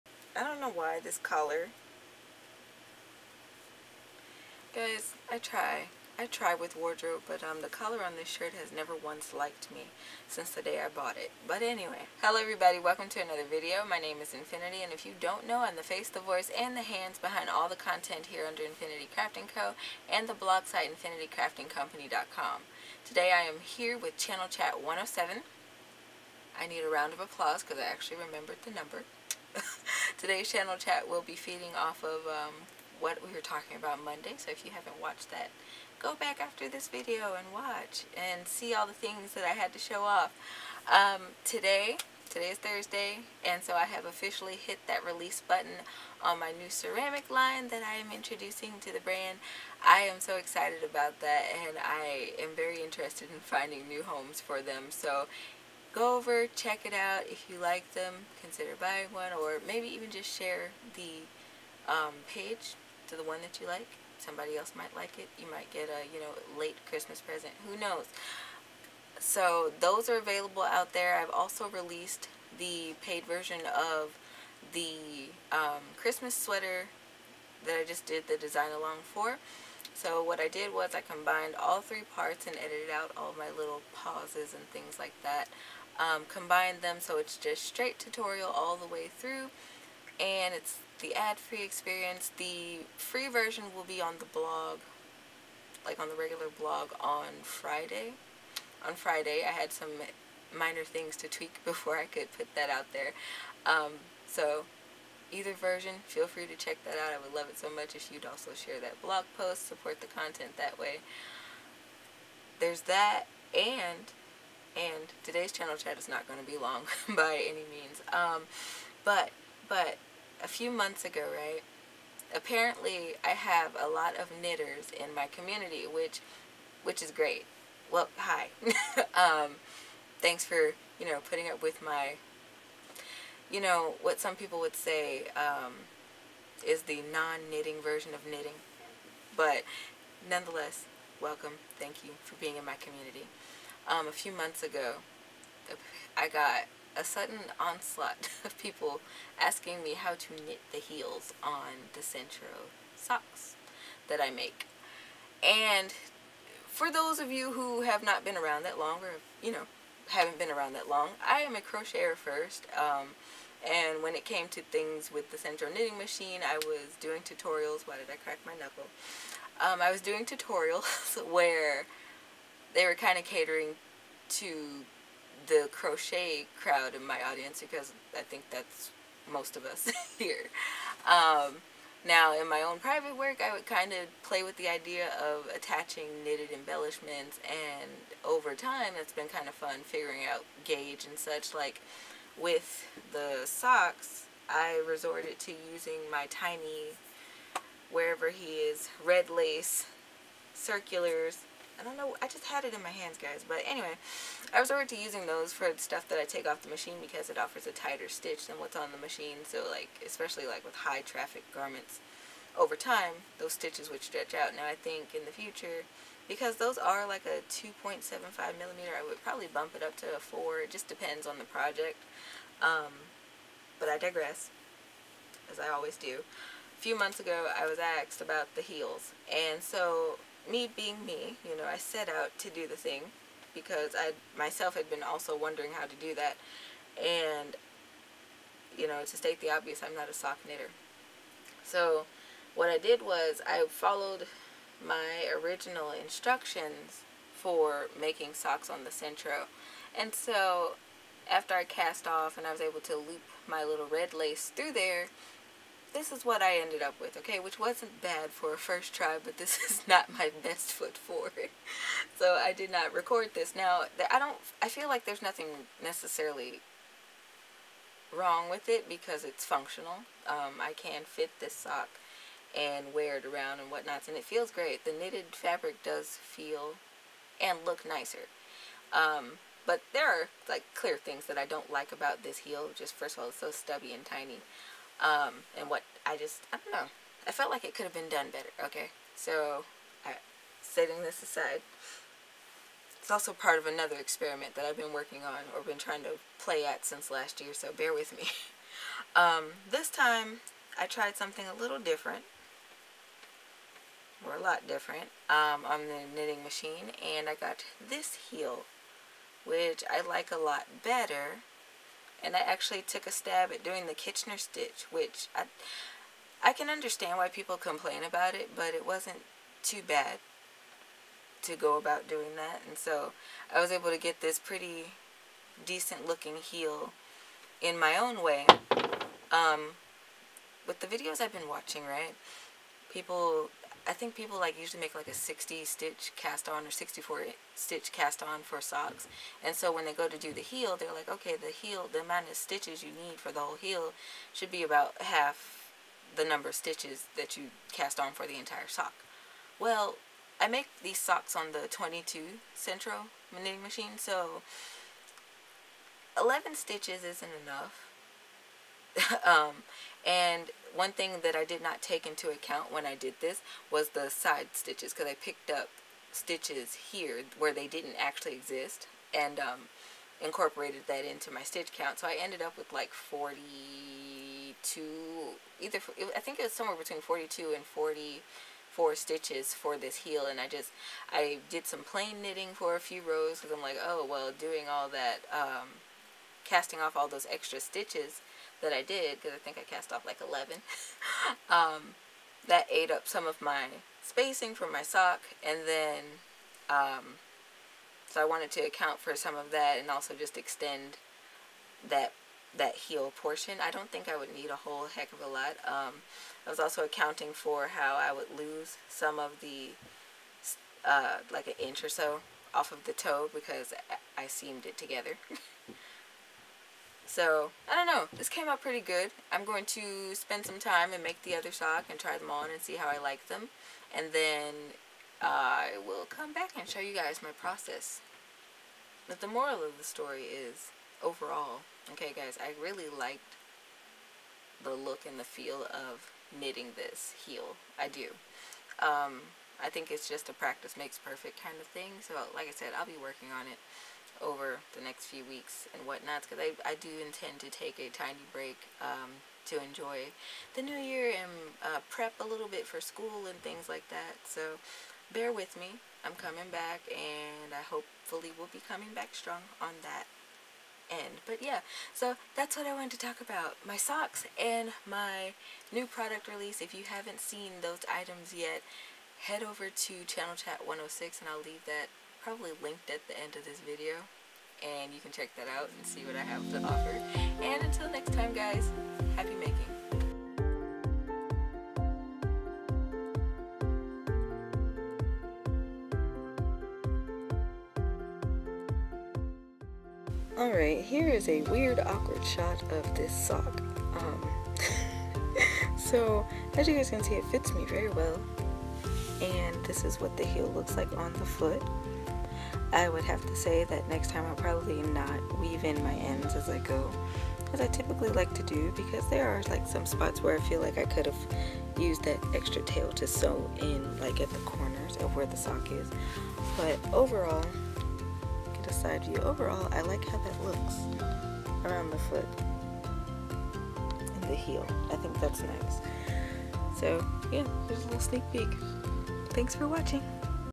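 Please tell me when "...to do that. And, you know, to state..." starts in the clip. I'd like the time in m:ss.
3:55.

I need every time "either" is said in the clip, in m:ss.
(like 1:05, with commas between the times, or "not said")
1:45, 6:15.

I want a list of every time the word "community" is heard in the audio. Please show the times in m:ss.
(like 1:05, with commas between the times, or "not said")
2:05, 2:22.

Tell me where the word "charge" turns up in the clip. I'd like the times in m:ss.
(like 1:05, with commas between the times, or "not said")
not said.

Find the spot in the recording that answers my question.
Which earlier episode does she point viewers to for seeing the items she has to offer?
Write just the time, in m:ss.
7:50.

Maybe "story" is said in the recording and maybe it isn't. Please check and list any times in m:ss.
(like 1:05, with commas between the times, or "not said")
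7:09.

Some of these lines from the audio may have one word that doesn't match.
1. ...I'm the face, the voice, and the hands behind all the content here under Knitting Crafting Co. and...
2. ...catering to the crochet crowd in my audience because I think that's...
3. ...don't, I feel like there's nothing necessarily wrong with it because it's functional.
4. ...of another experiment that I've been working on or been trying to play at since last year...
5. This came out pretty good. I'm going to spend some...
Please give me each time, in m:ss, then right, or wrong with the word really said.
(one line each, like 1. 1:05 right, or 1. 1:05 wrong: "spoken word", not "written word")
1. 0:15 wrong: "Infiniti", not "Knitting"
2. 2:53 right
3. 4:24 right
4. 4:53 right
5. 6:58 right.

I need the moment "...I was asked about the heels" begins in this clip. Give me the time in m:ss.
3:47.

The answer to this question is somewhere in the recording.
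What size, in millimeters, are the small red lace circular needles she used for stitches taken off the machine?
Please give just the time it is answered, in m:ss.
3:37.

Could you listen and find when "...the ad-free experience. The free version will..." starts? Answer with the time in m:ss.
1:30.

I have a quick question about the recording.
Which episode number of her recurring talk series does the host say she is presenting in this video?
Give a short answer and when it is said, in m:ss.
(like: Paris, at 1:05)
107, at 0:24.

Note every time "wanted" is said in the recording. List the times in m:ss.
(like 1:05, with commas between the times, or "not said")
6:38, 7:42.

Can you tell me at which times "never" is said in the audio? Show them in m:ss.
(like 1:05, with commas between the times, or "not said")
0:08.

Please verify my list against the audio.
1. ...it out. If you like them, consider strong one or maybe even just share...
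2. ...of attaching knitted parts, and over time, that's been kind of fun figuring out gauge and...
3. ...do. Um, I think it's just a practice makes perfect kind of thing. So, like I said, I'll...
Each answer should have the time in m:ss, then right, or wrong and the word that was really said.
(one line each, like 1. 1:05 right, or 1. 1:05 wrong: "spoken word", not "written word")
1. 0:56 wrong: "buying", not "strong"
2. 3:05 wrong: "embellishments", not "parts"
3. 7:17 right.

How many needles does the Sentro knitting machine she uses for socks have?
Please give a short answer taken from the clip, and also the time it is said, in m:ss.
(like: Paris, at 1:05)
22, at 5:51.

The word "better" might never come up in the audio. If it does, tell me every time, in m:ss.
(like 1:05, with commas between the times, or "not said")
4:48, 5:10.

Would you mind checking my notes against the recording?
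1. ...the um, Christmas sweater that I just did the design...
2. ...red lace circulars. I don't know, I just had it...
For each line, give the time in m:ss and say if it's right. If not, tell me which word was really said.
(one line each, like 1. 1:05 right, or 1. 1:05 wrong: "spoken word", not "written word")
1. 1:14 right
2. 3:19 right.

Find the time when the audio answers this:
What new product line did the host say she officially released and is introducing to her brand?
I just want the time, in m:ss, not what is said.
0:46.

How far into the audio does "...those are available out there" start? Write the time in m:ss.
1:09.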